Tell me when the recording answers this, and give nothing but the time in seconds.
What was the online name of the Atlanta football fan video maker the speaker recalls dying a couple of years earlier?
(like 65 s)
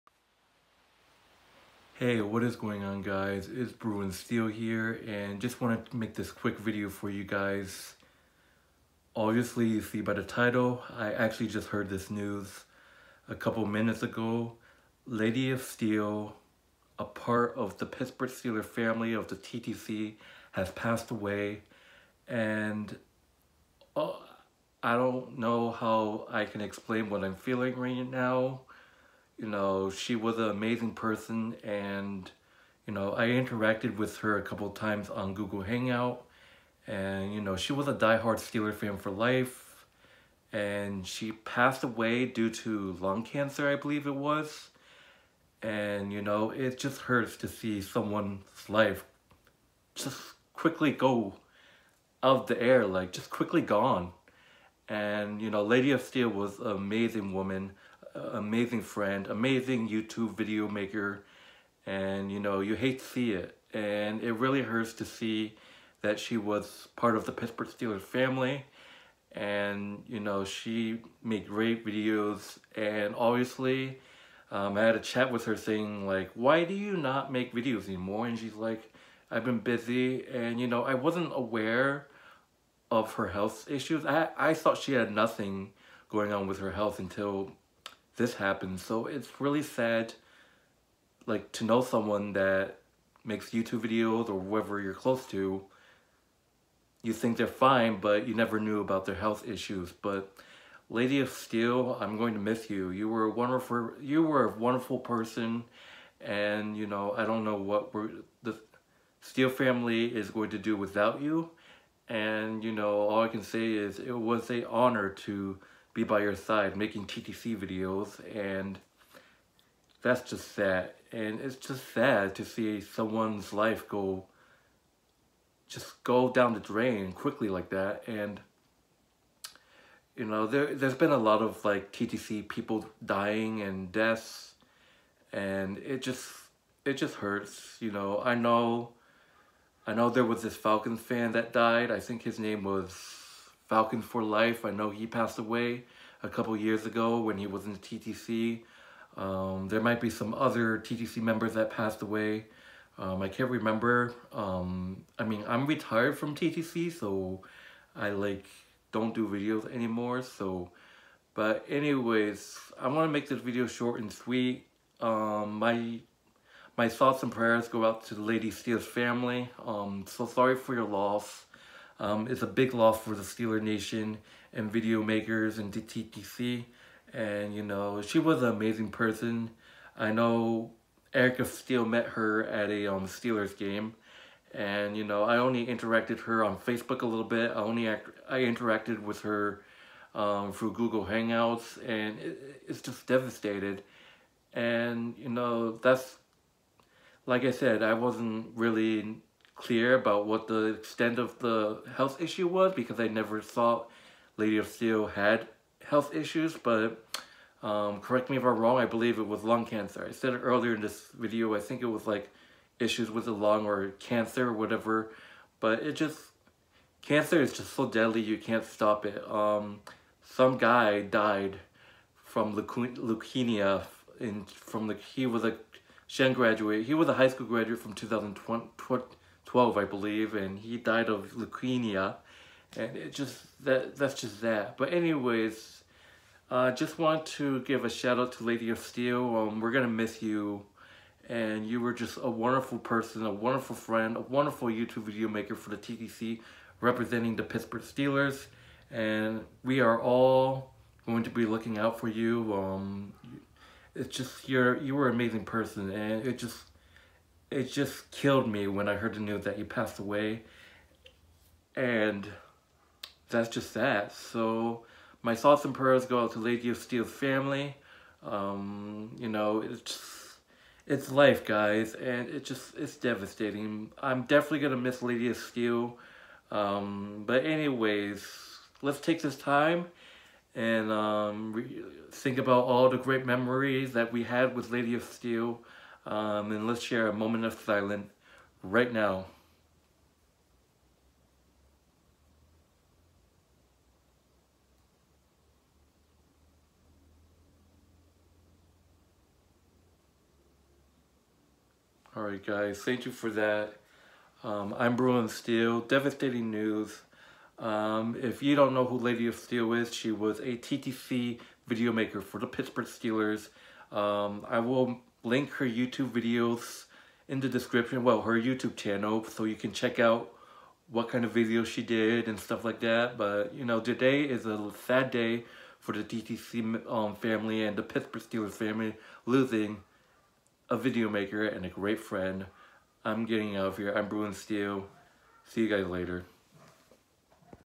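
143 s.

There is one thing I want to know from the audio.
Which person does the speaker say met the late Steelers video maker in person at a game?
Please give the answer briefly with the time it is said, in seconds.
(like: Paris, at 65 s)
Erica Steele, at 181 s.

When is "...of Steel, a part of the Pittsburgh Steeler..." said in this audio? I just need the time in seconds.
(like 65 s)
15 s.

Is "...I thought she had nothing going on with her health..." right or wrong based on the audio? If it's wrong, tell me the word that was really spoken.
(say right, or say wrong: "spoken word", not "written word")
right.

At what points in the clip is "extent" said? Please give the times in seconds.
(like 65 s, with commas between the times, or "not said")
200 s.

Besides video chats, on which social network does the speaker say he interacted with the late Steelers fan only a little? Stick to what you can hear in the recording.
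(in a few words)
Facebook.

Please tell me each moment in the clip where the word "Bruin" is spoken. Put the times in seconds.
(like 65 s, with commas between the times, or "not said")
3 s, 304 s, 334 s.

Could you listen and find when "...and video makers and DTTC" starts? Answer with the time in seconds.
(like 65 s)
174 s.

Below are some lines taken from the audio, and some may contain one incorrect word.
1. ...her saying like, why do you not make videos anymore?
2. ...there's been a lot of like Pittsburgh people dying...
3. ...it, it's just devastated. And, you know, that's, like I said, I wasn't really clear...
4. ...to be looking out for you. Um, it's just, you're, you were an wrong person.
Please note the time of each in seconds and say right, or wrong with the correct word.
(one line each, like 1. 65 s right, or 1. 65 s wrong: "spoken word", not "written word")
1. 75 s right
2. 130 s wrong: "TTC", not "Pittsburgh"
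3. 192 s right
4. 251 s wrong: "amazing", not "wrong".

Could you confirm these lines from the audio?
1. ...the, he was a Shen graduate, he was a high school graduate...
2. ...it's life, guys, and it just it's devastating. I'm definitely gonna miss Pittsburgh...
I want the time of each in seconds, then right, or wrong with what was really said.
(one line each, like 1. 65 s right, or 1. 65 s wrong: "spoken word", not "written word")
1. 224 s right
2. 270 s wrong: "Lady", not "Pittsburgh".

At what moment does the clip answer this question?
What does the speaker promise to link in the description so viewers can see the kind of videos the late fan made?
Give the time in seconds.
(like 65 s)
318 s.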